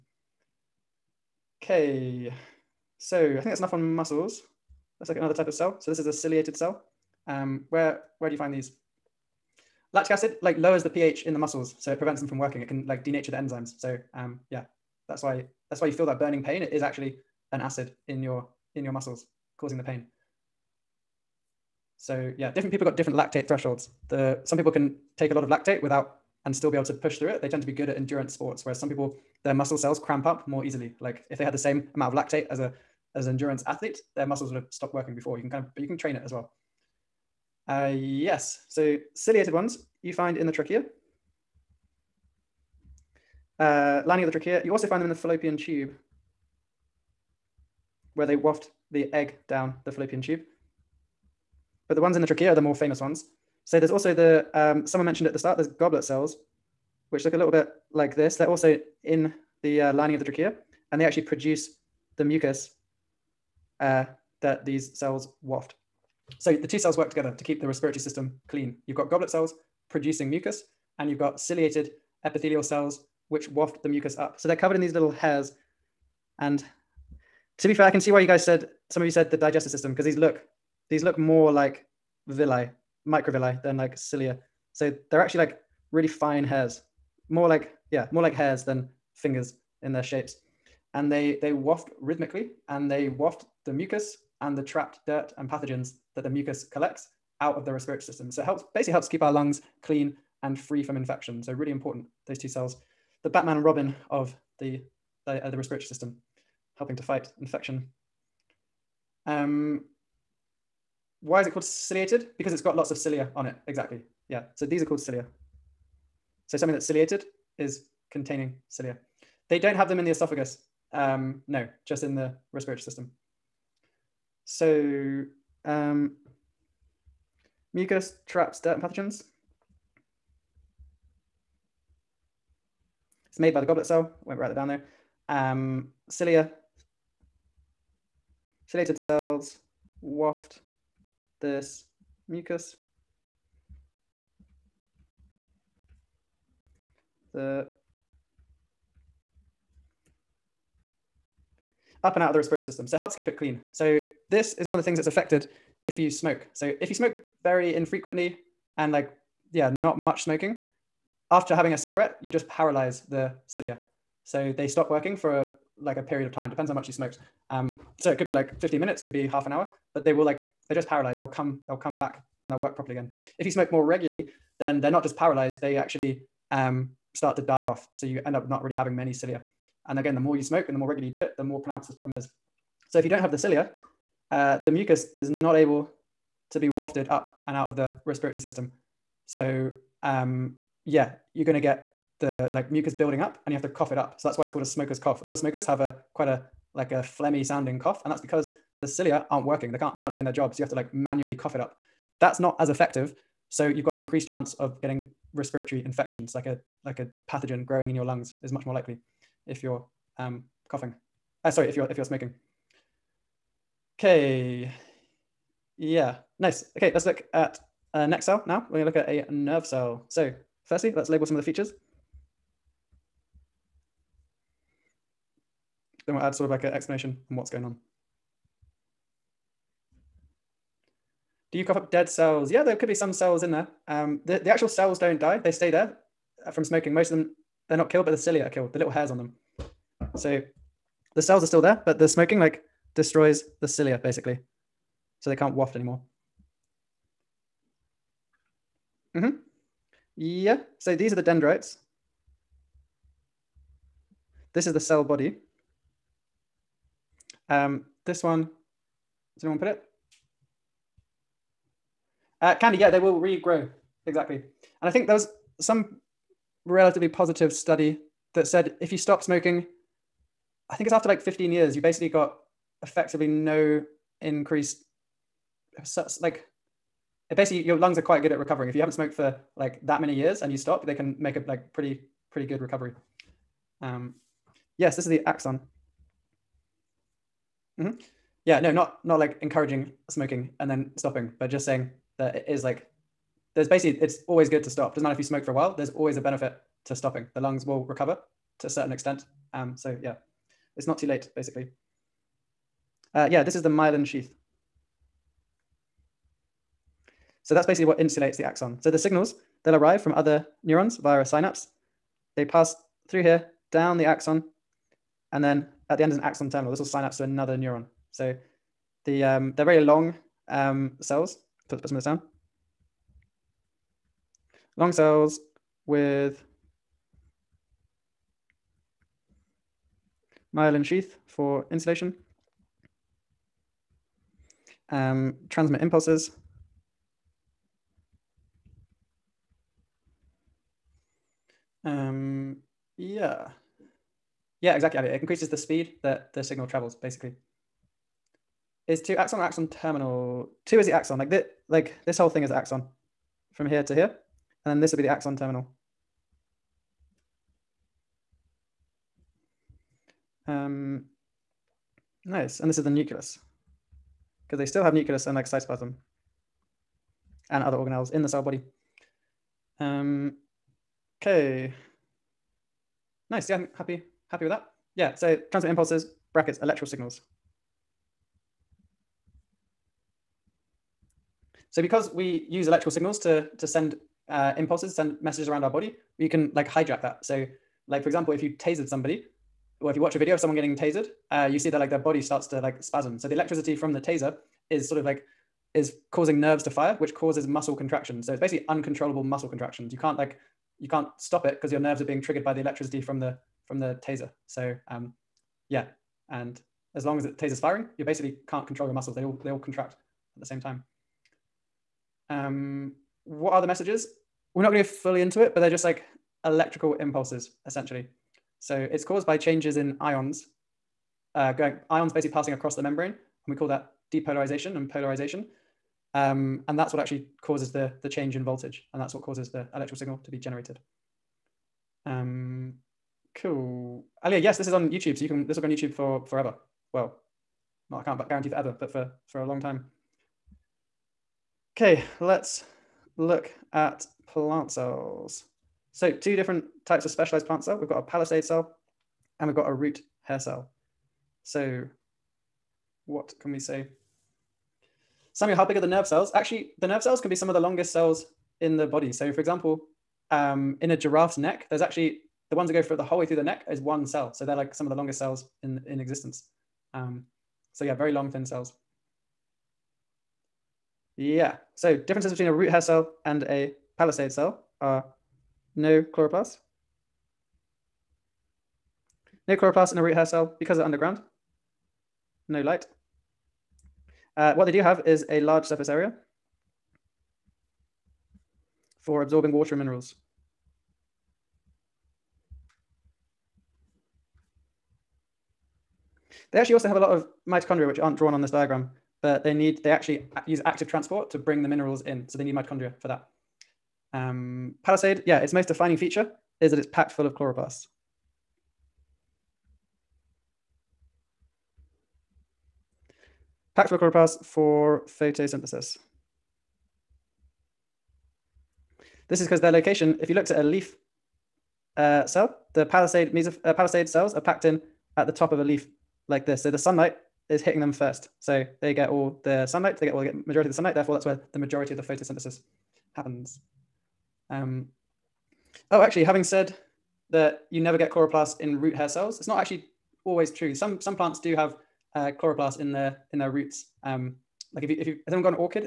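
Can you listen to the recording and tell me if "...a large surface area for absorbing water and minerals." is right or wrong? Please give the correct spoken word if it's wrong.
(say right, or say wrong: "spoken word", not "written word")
right.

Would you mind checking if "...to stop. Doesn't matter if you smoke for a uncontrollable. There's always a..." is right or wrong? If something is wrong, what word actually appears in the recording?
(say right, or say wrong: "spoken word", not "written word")
wrong: "while", not "uncontrollable".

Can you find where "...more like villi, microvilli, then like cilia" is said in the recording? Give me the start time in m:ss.
1:21.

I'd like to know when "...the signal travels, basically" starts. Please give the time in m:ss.
5:46.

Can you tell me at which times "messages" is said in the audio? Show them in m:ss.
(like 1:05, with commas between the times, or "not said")
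6:25, 6:53.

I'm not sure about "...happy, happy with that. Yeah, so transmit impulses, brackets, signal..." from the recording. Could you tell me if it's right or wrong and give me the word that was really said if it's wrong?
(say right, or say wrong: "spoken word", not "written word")
wrong: "electrical", not "signal".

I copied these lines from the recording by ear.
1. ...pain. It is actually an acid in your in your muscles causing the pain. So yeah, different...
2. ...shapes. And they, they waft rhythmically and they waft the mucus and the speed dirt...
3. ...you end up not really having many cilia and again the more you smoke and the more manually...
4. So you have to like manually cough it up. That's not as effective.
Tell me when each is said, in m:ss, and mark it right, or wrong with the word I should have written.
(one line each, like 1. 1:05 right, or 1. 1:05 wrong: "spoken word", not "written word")
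1. 0:16 right
2. 1:30 wrong: "trapped", not "speed"
3. 2:58 wrong: "regularly", not "manually"
4. 3:20 right.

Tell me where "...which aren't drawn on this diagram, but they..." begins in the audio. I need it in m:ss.
8:17.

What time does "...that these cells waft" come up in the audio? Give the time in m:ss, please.
1:04.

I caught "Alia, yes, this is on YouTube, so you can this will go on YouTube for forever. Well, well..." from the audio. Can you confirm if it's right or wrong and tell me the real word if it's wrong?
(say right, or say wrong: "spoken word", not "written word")
right.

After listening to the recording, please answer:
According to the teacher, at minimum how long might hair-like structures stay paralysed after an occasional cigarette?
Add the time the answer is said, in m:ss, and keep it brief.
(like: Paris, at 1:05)
15 minutes, at 2:48.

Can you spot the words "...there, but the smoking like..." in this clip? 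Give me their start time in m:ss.
4:01.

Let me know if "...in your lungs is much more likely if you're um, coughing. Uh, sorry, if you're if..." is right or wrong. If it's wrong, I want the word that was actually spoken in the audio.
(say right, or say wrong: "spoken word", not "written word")
right.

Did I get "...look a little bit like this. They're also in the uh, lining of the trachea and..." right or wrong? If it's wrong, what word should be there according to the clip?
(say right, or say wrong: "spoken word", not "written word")
right.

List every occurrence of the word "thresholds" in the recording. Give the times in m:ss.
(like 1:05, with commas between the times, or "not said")
0:23.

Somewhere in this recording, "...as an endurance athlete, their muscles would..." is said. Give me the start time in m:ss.
0:33.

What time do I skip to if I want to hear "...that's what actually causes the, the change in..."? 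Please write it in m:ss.
7:06.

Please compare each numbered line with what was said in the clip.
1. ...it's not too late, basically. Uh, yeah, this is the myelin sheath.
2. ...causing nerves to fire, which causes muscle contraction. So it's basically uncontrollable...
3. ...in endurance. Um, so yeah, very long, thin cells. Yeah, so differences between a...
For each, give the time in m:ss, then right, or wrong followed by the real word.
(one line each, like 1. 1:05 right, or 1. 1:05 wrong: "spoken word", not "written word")
1. 5:00 right
2. 6:36 right
3. 7:45 wrong: "existence", not "endurance".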